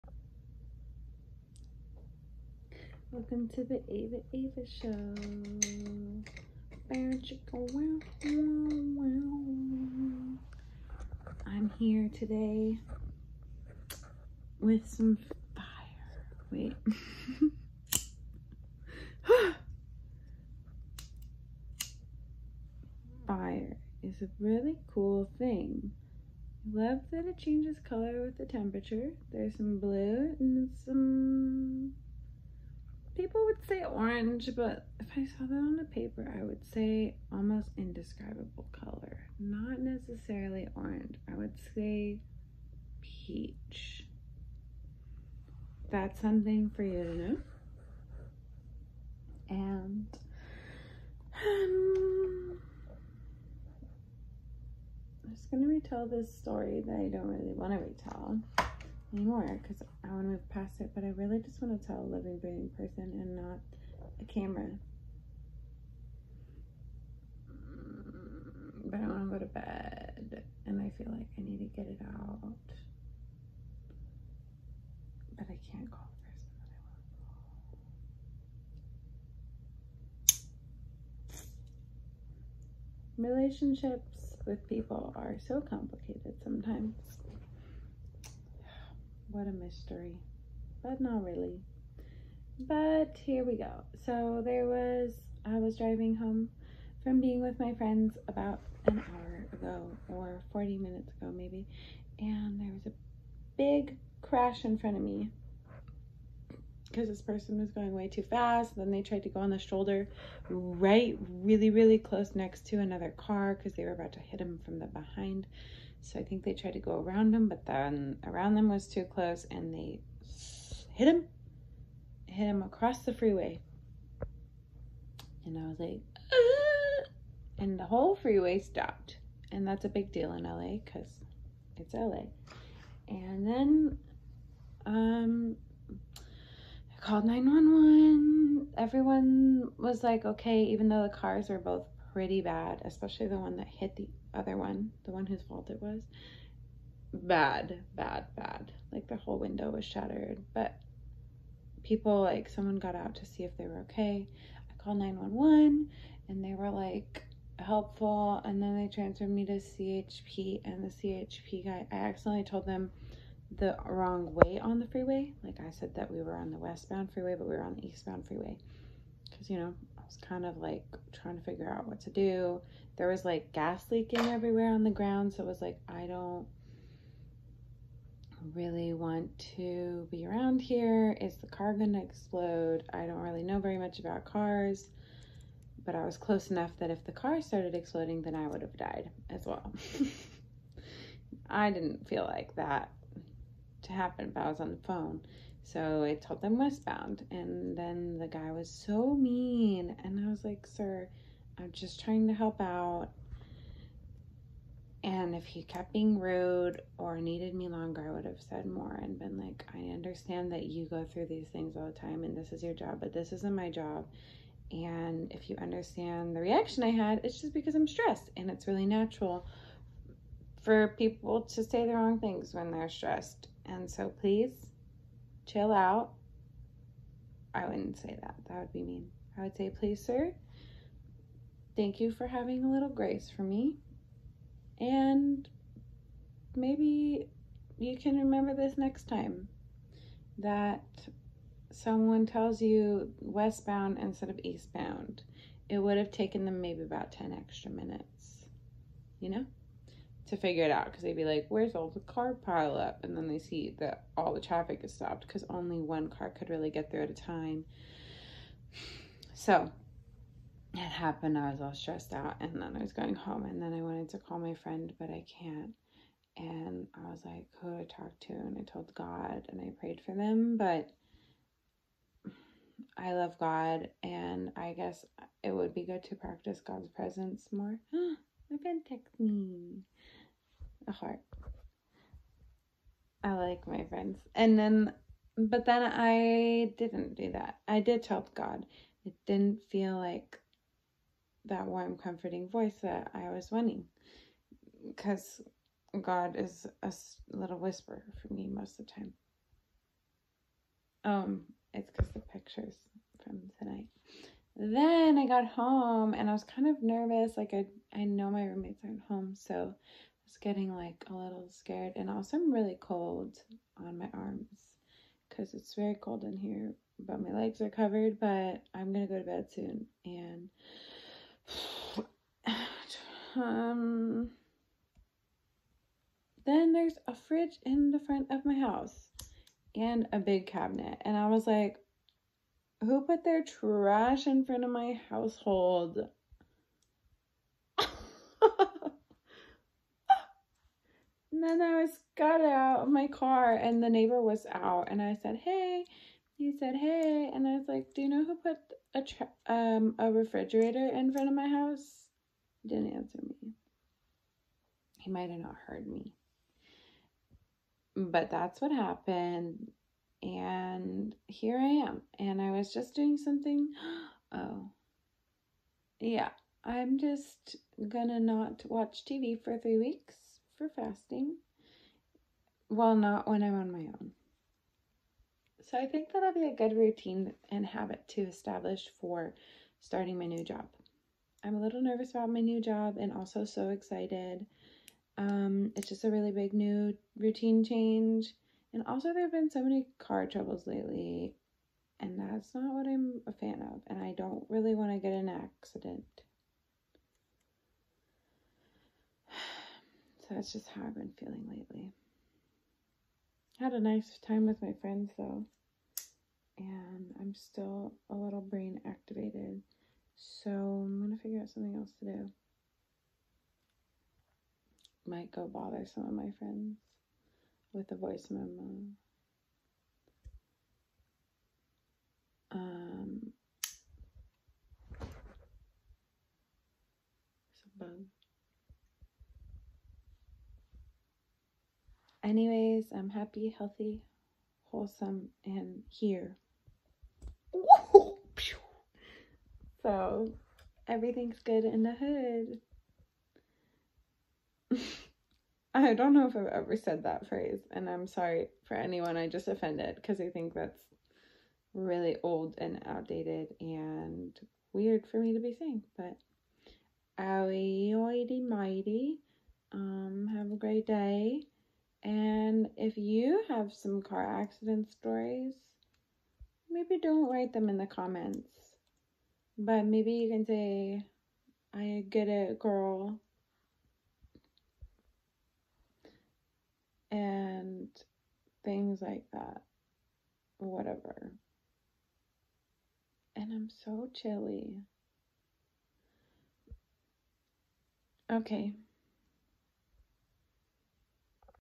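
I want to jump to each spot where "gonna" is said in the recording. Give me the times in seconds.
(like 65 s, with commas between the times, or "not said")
318 s, 367 s.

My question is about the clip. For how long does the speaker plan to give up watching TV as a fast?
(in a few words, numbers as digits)
3 weeks.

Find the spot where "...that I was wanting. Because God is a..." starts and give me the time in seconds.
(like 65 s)
292 s.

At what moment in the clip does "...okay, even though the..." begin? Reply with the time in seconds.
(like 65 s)
140 s.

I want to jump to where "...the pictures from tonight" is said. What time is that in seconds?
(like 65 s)
302 s.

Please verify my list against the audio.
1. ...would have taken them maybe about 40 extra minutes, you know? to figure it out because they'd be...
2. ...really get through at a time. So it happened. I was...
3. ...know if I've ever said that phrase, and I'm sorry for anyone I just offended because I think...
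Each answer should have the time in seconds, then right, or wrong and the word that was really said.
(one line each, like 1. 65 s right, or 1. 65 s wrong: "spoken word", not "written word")
1. 245 s wrong: "10", not "40"
2. 256 s right
3. 446 s right.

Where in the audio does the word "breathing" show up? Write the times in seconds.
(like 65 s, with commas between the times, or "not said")
62 s.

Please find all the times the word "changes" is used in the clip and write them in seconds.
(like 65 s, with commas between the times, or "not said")
27 s, 387 s.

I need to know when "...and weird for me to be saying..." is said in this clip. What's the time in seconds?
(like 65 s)
453 s.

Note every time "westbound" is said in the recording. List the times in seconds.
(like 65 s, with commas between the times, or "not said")
166 s, 196 s, 243 s.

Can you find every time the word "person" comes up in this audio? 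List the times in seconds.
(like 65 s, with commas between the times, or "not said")
62 s, 76 s, 107 s.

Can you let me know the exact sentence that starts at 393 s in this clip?
And I don't really want to get an accident.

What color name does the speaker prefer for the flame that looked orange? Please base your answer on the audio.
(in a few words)
Peach.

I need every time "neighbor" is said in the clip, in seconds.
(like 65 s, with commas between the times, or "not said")
343 s.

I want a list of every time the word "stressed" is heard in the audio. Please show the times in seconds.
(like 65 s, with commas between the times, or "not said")
217 s, 222 s, 261 s.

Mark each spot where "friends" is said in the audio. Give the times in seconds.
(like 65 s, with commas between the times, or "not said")
97 s, 264 s, 278 s, 283 s, 404 s, 416 s.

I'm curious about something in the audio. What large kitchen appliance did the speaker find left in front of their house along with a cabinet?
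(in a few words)
A fridge.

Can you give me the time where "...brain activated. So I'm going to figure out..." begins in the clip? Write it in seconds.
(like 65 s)
408 s.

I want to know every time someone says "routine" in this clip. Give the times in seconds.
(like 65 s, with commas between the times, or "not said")
376 s, 387 s.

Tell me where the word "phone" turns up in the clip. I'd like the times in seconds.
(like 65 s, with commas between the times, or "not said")
194 s.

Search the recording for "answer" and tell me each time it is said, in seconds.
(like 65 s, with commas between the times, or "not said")
352 s.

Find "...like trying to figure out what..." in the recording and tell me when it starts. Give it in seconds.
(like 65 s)
170 s.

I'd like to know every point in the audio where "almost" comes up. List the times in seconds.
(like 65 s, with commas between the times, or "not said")
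37 s.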